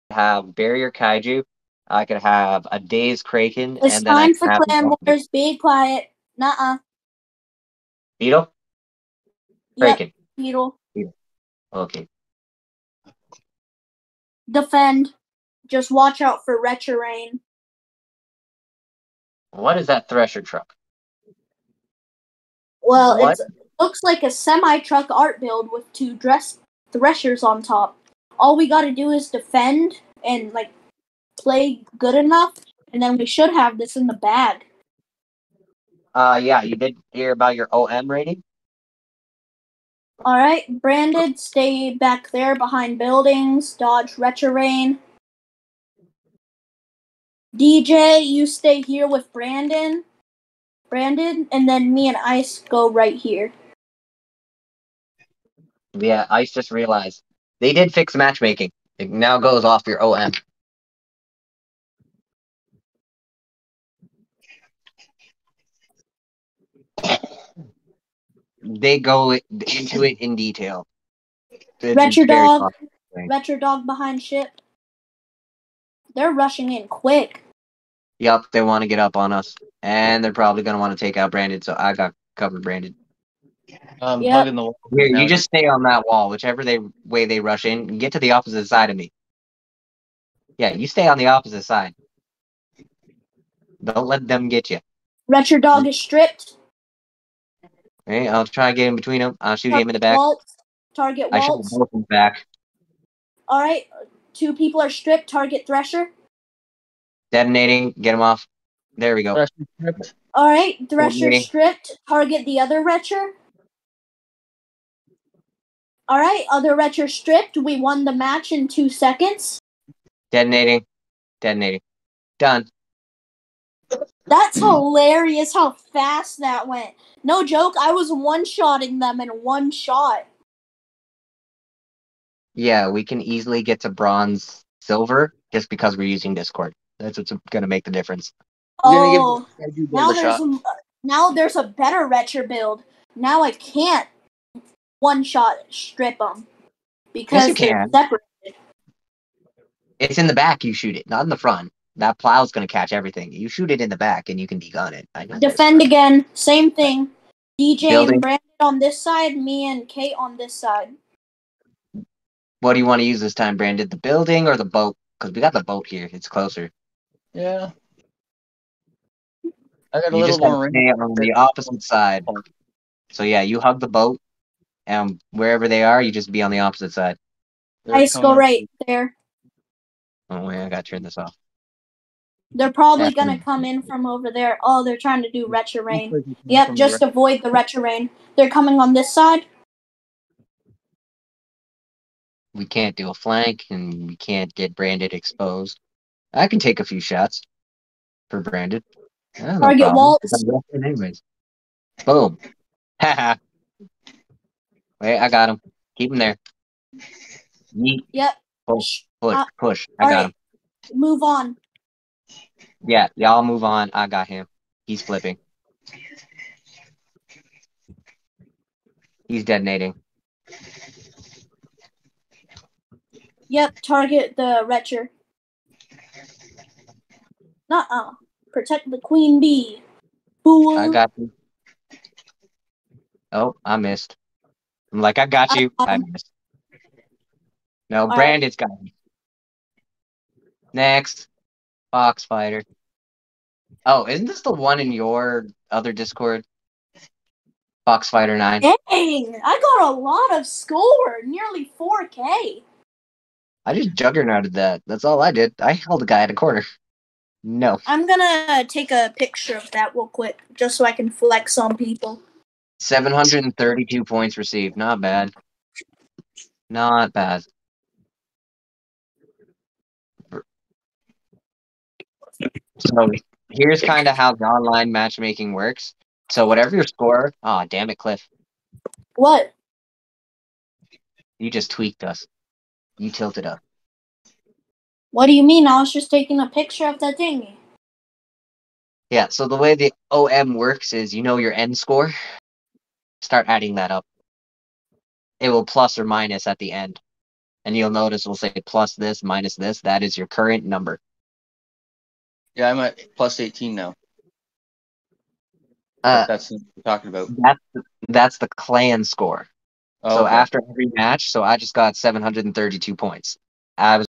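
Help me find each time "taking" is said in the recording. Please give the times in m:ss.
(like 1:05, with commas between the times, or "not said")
4:46.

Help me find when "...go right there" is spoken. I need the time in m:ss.
2:58.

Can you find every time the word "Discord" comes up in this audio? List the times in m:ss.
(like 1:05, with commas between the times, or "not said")
2:16, 4:05.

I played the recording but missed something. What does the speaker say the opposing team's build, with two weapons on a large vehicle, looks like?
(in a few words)
Semi truck.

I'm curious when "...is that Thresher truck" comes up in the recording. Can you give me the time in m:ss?
0:19.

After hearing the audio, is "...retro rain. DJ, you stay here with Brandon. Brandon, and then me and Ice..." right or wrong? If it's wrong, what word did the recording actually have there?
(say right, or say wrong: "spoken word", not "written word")
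right.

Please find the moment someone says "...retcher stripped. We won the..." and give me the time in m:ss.
1:56.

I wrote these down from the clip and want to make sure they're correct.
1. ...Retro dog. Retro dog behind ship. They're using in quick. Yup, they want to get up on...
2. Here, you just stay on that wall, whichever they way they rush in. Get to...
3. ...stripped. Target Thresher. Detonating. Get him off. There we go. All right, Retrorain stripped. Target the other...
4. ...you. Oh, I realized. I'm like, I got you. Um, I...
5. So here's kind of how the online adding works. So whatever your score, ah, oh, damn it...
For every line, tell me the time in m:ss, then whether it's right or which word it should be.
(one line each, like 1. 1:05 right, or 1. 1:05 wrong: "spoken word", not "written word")
1. 1:11 wrong: "rushing", not "using"
2. 1:24 right
3. 1:44 wrong: "Thresher", not "Retrorain"
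4. 3:51 wrong: "missed", not "realized"
5. 4:32 wrong: "matchmaking", not "adding".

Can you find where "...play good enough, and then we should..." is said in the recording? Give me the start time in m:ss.
0:31.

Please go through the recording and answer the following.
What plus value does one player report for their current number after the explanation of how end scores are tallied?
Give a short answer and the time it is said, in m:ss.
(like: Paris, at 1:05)
Plus 18, at 5:03.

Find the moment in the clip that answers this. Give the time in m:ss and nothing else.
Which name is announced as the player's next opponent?
4:07.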